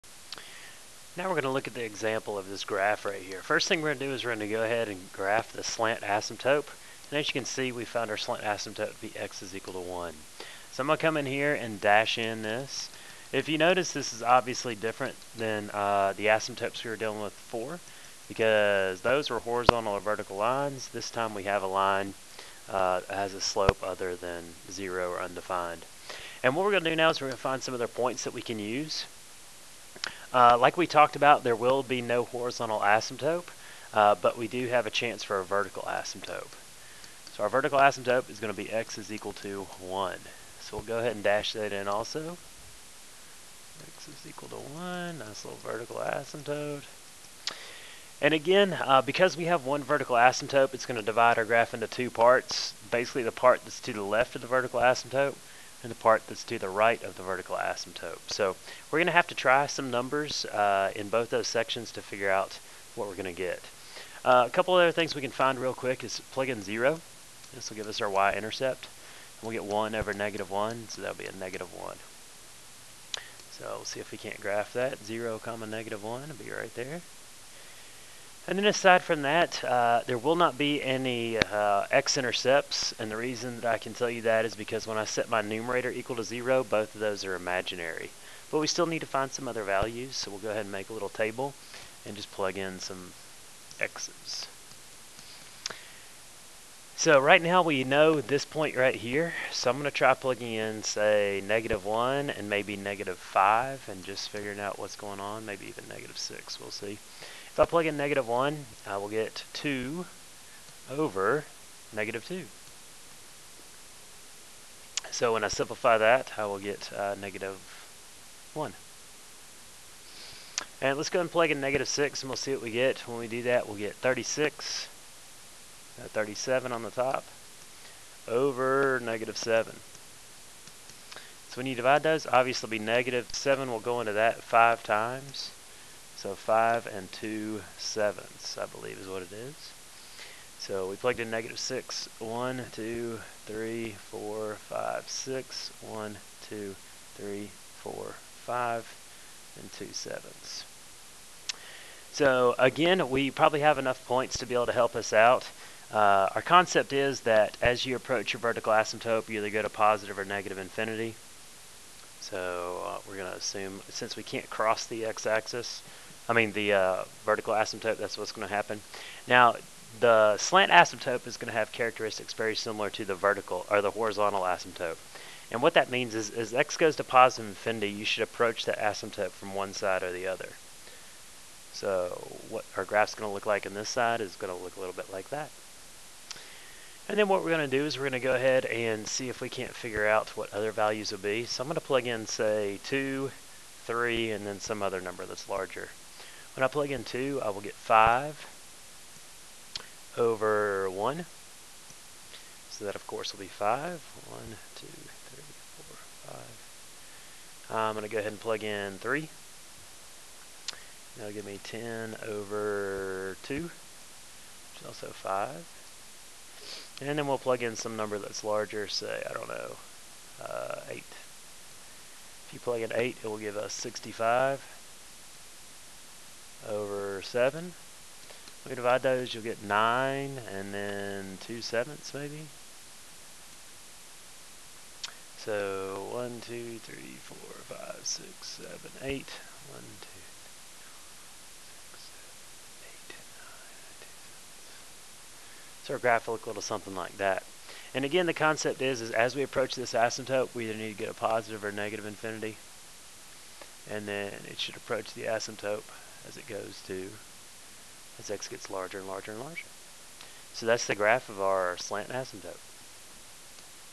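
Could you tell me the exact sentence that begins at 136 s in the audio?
So 5 and 2 sevenths, I believe is what it is.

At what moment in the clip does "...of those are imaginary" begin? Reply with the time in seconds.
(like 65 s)
86 s.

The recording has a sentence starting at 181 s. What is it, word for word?
So what our graph's going to look like on this side is going to look a little bit like that.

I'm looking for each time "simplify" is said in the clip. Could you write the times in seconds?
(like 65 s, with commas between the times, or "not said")
115 s.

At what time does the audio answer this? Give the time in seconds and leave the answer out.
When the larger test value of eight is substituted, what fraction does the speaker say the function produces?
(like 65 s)
223 s.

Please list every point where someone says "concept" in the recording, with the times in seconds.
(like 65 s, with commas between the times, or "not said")
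156 s, 248 s.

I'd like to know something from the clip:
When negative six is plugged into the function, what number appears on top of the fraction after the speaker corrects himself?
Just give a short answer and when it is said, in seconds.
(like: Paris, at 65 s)
37, at 126 s.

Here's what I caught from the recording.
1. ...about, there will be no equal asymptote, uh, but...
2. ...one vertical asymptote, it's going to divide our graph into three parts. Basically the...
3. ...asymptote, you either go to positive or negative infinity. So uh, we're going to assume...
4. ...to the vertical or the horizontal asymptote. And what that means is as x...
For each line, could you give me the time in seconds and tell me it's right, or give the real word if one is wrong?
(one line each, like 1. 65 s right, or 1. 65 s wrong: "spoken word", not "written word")
1. 31 s wrong: "horizontal", not "equal"
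2. 49 s wrong: "two", not "three"
3. 158 s right
4. 172 s right.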